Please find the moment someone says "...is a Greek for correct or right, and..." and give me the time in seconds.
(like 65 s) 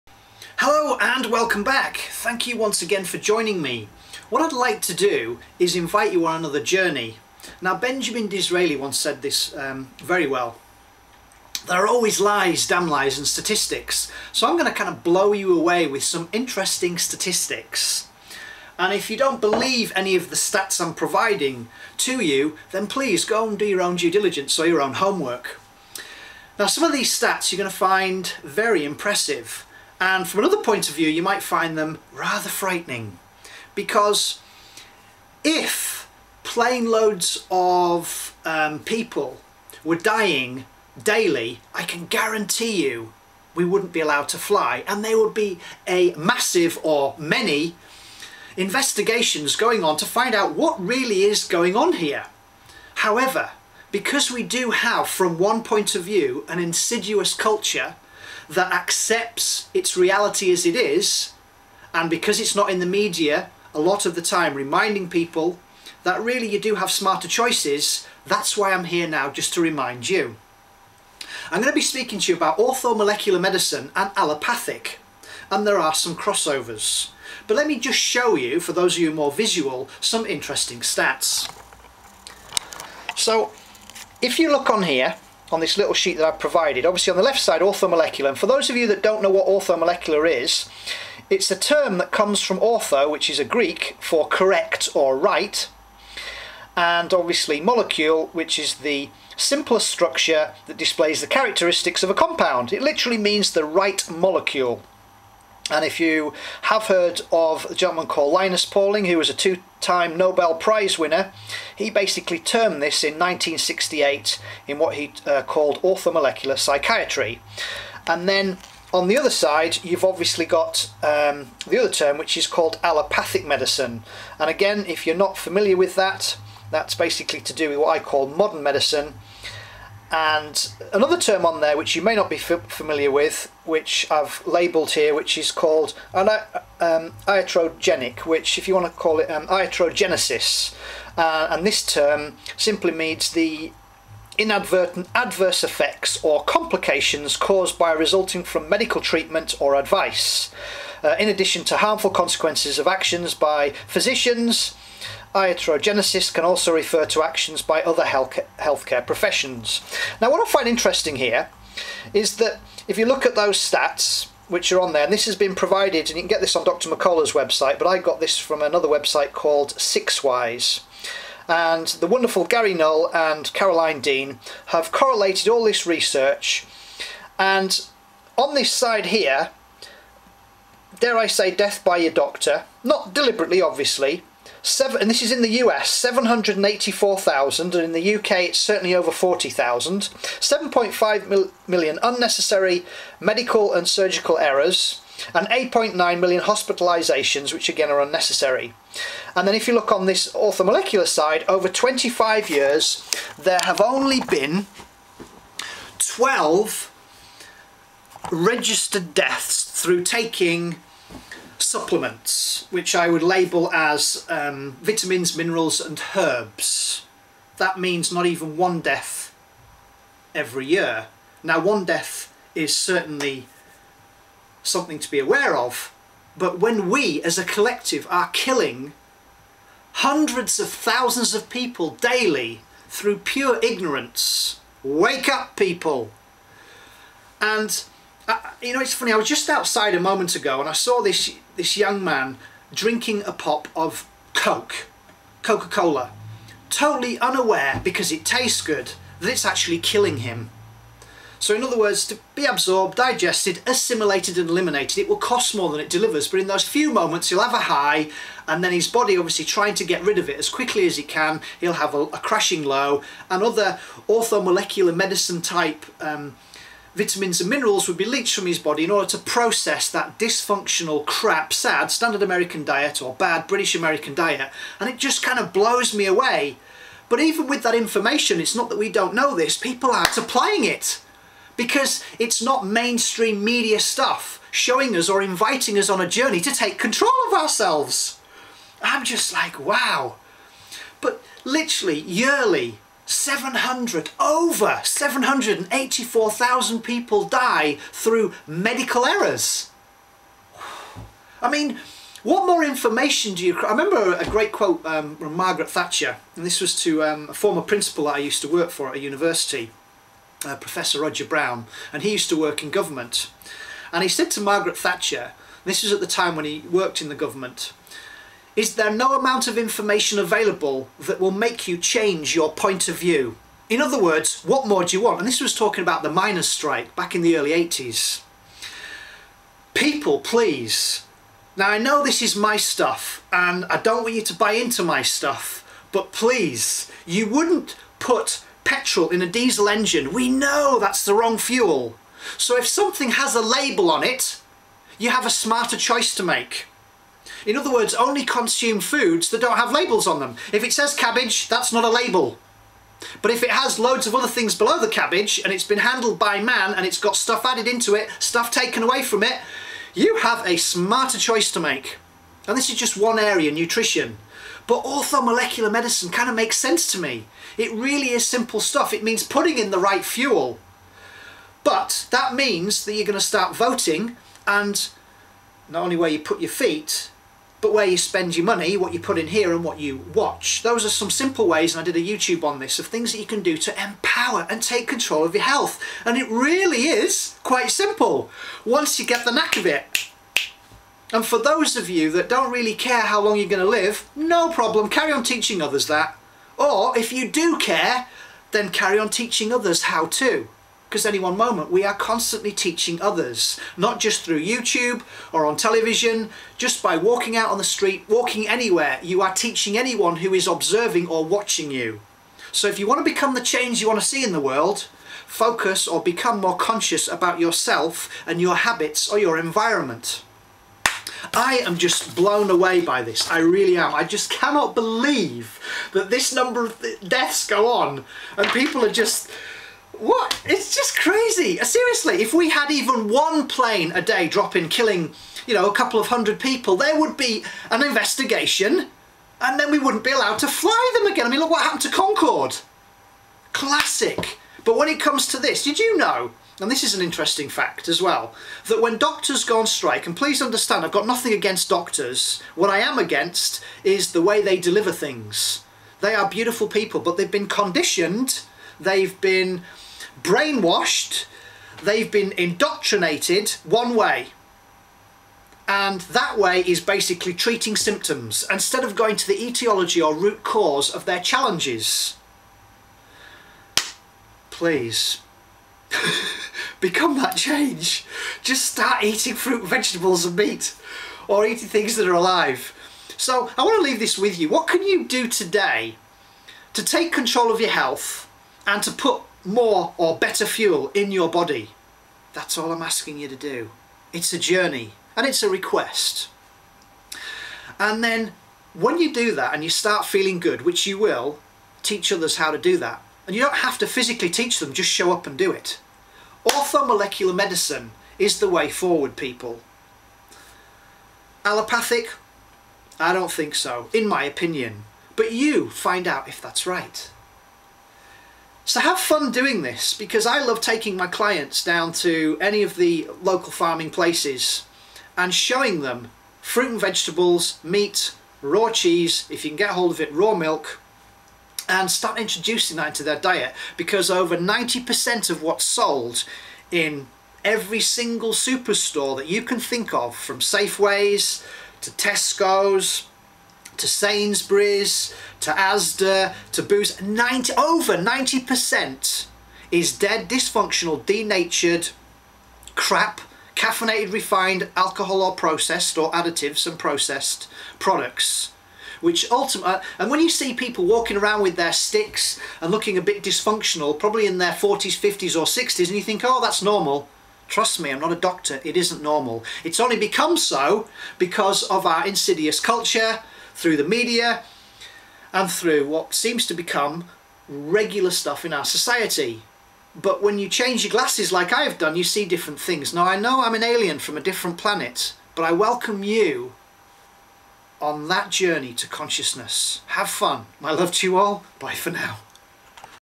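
93 s.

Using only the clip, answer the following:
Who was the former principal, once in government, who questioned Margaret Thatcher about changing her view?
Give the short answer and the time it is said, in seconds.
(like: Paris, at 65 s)
Roger Brown, at 311 s.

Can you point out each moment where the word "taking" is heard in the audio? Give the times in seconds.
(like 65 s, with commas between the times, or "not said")
210 s, 520 s.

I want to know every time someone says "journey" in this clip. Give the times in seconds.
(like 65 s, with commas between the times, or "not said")
6 s, 286 s, 494 s, 588 s.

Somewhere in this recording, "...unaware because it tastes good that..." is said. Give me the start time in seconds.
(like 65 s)
247 s.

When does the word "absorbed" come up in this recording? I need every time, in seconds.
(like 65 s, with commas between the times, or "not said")
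252 s.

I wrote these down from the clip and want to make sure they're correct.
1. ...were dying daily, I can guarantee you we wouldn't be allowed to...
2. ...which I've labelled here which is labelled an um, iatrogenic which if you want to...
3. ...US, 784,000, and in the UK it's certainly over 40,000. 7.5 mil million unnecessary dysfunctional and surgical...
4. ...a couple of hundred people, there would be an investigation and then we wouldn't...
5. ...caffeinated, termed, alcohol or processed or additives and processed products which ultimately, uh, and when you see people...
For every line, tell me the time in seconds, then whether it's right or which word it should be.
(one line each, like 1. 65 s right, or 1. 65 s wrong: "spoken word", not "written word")
1. 39 s right
2. 133 s wrong: "called", not "labelled"
3. 185 s wrong: "medical", not "dysfunctional"
4. 435 s right
5. 553 s wrong: "refined", not "termed".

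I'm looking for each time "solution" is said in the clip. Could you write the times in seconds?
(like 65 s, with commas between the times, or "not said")
not said.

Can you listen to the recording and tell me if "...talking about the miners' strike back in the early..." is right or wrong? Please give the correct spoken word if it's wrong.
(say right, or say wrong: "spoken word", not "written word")
right.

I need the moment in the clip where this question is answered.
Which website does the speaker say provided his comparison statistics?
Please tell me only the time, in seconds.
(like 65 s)
169 s.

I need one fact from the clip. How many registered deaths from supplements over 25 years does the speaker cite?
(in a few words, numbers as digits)
12.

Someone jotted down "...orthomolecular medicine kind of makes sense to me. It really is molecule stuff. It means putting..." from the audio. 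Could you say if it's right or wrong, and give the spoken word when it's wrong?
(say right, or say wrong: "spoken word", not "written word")
wrong: "simple", not "molecule".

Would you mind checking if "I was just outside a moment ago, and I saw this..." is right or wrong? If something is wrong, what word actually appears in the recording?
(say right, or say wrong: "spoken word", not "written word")
right.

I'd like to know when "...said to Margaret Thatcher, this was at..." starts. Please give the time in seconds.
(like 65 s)
314 s.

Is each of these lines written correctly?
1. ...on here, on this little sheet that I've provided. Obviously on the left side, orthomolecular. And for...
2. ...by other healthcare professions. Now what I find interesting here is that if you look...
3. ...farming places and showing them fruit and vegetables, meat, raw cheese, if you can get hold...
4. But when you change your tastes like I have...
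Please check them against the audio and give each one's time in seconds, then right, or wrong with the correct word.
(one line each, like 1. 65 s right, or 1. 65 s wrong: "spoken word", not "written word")
1. 84 s right
2. 157 s right
3. 523 s right
4. 579 s wrong: "glasses", not "tastes".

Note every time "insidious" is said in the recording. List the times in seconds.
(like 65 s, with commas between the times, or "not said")
56 s, 572 s.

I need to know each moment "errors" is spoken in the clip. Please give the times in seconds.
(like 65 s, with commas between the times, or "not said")
194 s, 299 s.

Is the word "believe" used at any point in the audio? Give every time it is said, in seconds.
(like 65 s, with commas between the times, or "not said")
19 s, 424 s.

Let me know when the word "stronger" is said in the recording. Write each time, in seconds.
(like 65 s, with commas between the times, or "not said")
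not said.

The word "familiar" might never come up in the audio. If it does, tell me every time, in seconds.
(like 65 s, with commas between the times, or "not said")
125 s, 132 s.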